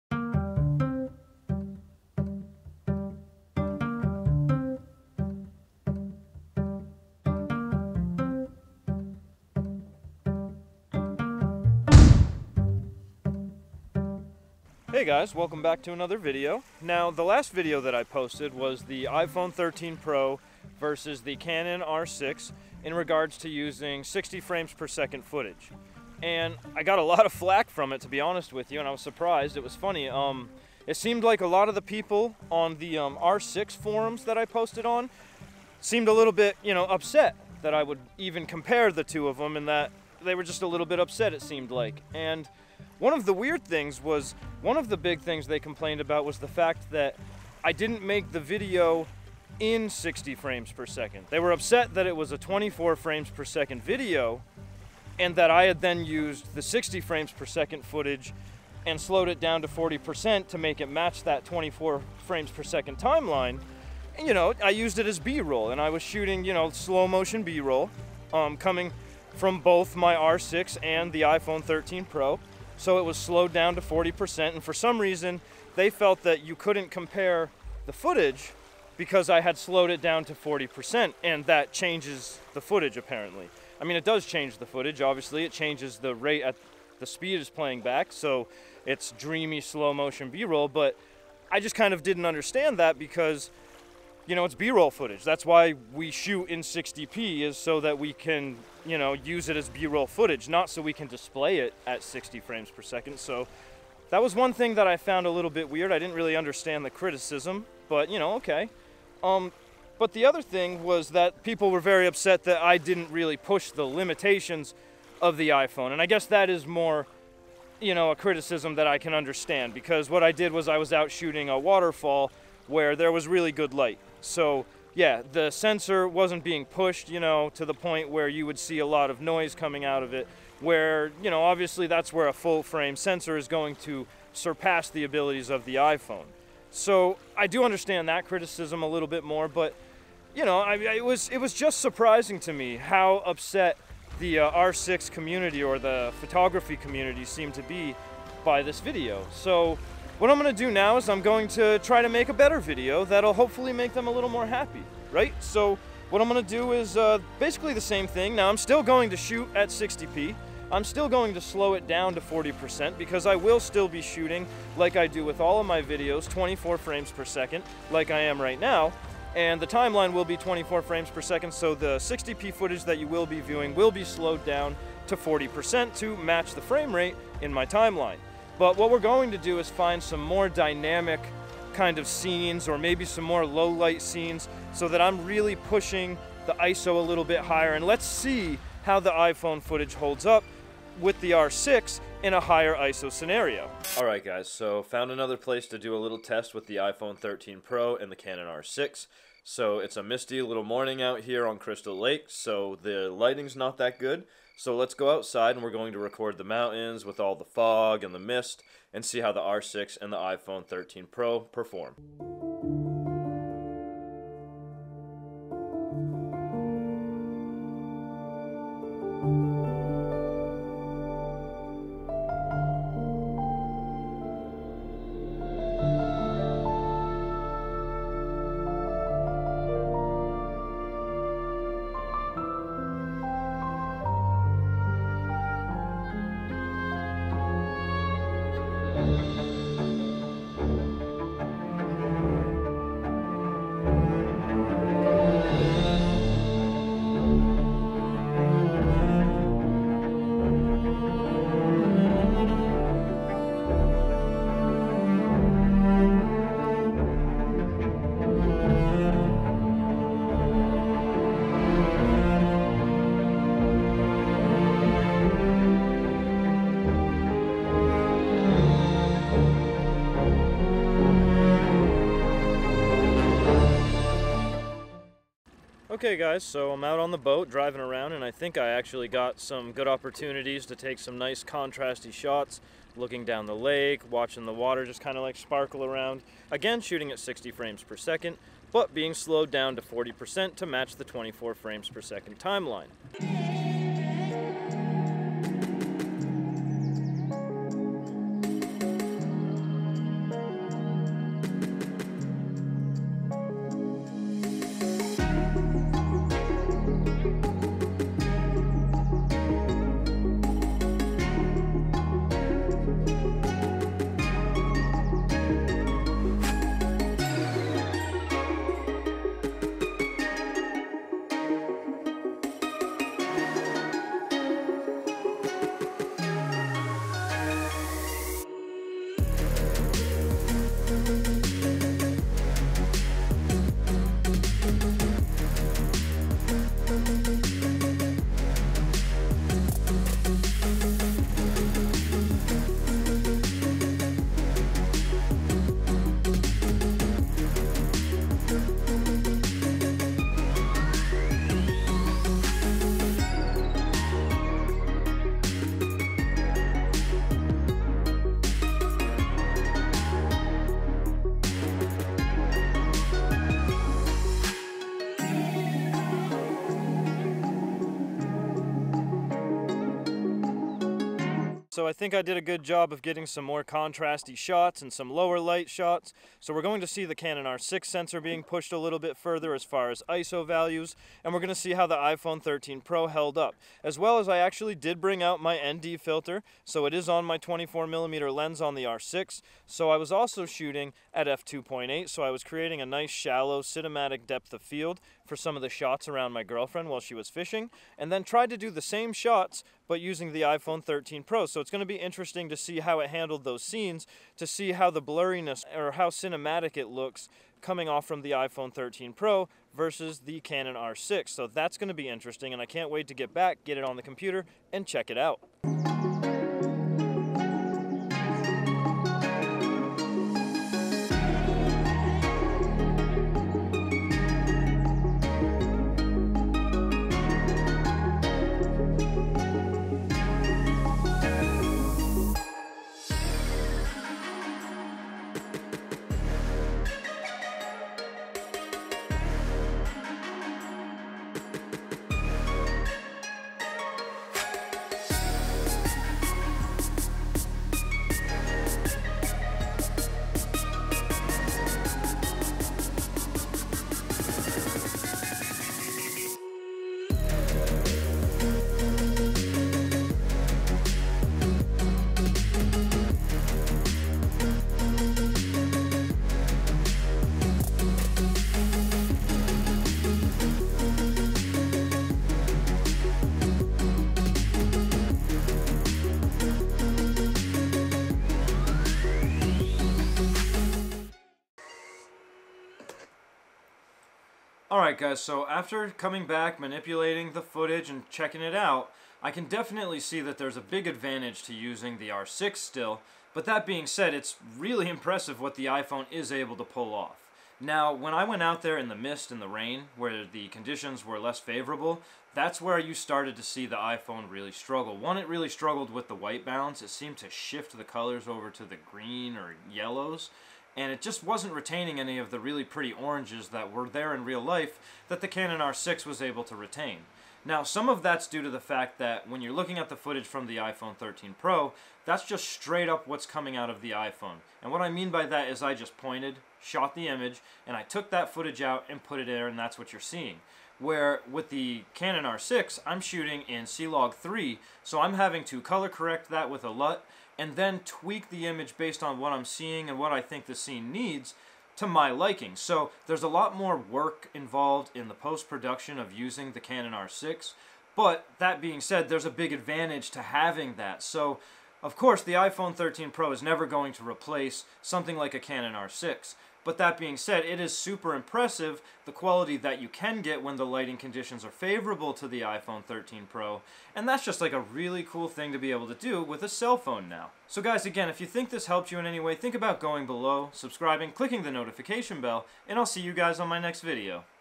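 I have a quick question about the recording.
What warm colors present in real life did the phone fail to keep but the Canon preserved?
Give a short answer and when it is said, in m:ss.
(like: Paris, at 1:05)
Oranges, at 8:32.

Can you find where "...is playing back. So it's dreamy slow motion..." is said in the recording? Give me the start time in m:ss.
1:27.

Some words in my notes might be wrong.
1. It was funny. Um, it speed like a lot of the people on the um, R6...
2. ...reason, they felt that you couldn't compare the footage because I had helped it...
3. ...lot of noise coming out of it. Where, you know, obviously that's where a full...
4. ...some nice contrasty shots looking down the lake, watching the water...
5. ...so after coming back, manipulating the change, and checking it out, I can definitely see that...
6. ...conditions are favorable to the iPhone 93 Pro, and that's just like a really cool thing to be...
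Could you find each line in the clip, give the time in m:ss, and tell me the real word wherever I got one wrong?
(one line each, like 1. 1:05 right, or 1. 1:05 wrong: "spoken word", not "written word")
1. 0:29 wrong: "seemed", not "speed"
2. 1:14 wrong: "slowed", not "helped"
3. 2:08 right
4. 4:40 right
5. 8:05 wrong: "footage", not "change"
6. 9:20 wrong: "13", not "93".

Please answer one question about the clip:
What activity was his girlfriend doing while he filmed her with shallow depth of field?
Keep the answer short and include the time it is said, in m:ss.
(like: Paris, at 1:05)
Fishing, at 6:37.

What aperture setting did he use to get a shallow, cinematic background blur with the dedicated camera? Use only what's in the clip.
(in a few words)
f2.8.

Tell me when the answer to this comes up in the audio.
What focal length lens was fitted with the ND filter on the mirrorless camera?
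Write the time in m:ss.
6:27.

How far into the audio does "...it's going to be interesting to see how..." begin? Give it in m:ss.
6:41.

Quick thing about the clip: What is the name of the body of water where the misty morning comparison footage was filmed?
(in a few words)
Crystal Lake.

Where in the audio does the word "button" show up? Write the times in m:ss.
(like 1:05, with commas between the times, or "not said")
not said.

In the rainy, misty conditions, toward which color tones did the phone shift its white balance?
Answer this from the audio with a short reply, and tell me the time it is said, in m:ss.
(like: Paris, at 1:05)
Green or yellows, at 8:28.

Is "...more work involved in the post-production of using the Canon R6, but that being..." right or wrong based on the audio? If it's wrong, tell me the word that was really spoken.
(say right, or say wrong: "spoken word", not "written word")
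right.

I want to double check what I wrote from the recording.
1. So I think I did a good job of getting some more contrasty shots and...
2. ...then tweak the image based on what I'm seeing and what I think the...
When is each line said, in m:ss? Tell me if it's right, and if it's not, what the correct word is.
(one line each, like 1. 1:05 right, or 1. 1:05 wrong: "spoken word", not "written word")
1. 6:11 right
2. 8:57 right.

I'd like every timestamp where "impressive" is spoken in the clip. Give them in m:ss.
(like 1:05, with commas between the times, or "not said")
8:14, 9:18.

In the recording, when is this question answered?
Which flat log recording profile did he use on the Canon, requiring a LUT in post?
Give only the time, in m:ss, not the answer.
8:53.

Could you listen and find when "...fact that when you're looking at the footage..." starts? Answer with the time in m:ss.
8:38.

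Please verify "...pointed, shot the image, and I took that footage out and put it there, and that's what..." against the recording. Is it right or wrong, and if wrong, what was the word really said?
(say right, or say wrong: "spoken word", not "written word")
right.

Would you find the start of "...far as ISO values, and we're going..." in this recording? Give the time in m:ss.
6:19.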